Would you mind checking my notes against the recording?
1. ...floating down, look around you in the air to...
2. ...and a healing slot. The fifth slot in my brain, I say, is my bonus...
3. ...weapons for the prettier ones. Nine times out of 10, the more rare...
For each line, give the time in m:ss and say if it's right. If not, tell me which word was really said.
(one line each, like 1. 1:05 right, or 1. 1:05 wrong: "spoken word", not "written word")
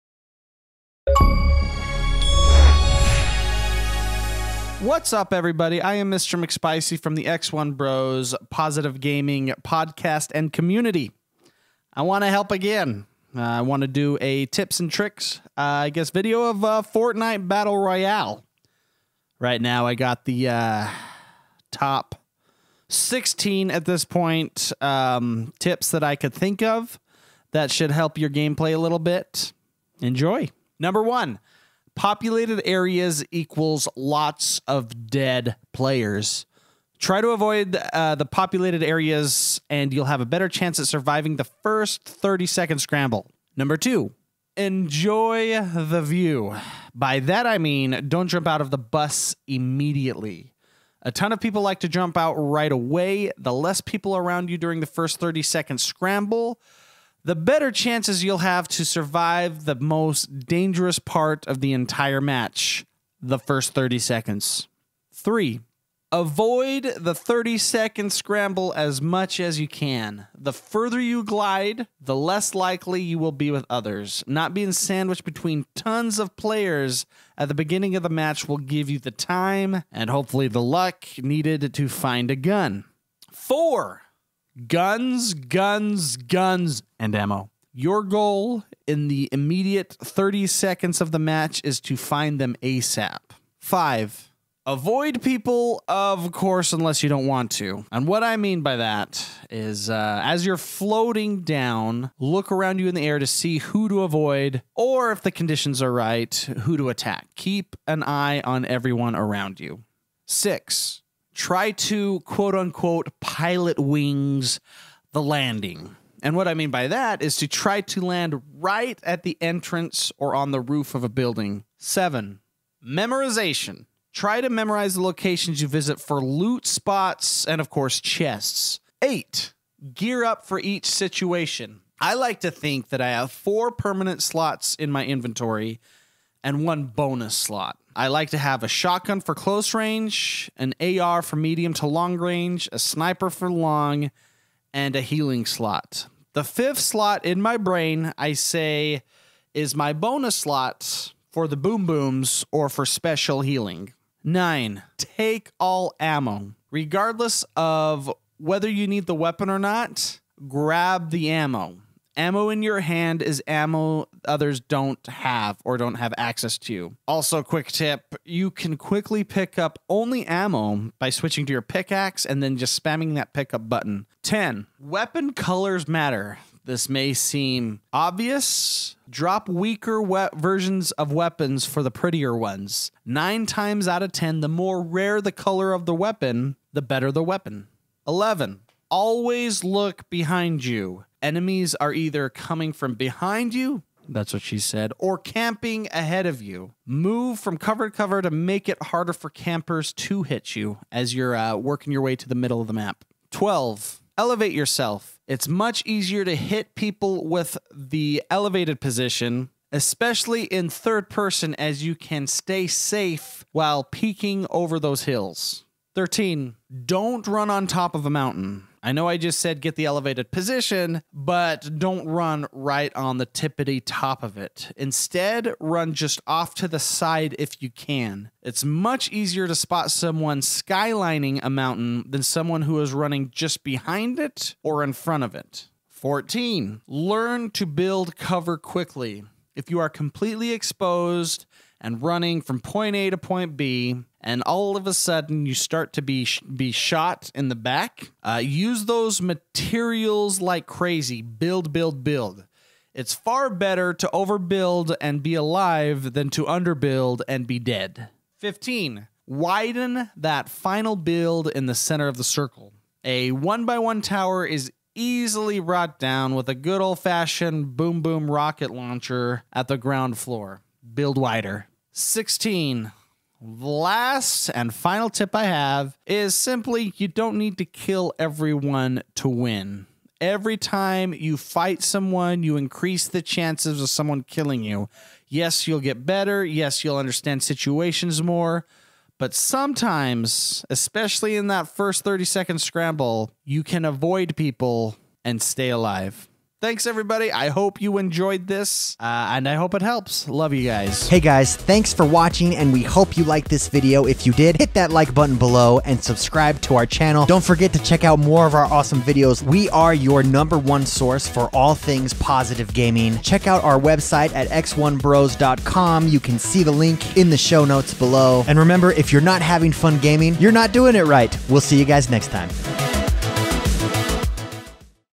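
1. 1:40 right
2. 2:24 right
3. 3:01 right.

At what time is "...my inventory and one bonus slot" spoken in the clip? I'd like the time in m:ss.
2:14.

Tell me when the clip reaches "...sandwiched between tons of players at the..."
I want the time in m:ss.
1:14.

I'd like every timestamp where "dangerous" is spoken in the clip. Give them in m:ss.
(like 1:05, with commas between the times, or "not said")
1:00.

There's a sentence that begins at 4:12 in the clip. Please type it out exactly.
It's far better to overbuild and be alive than to underbuild and be dead.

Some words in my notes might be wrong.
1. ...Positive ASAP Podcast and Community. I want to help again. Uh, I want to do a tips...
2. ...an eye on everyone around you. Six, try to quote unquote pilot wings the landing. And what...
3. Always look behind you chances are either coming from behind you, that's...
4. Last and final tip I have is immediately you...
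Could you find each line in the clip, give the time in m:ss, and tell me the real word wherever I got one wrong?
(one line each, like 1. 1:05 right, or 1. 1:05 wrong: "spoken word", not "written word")
1. 0:08 wrong: "Gaming", not "ASAP"
2. 1:47 right
3. 3:08 wrong: "enemies", not "chances"
4. 4:33 wrong: "simply", not "immediately".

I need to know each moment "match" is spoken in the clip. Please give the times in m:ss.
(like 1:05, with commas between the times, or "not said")
1:02, 1:18, 1:31.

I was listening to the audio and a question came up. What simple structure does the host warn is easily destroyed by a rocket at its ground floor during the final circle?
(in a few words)
one by one tower.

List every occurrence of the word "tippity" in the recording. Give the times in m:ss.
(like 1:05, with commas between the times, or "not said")
3:43.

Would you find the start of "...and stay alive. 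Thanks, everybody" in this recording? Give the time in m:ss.
4:55.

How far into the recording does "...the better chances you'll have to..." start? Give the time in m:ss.
0:57.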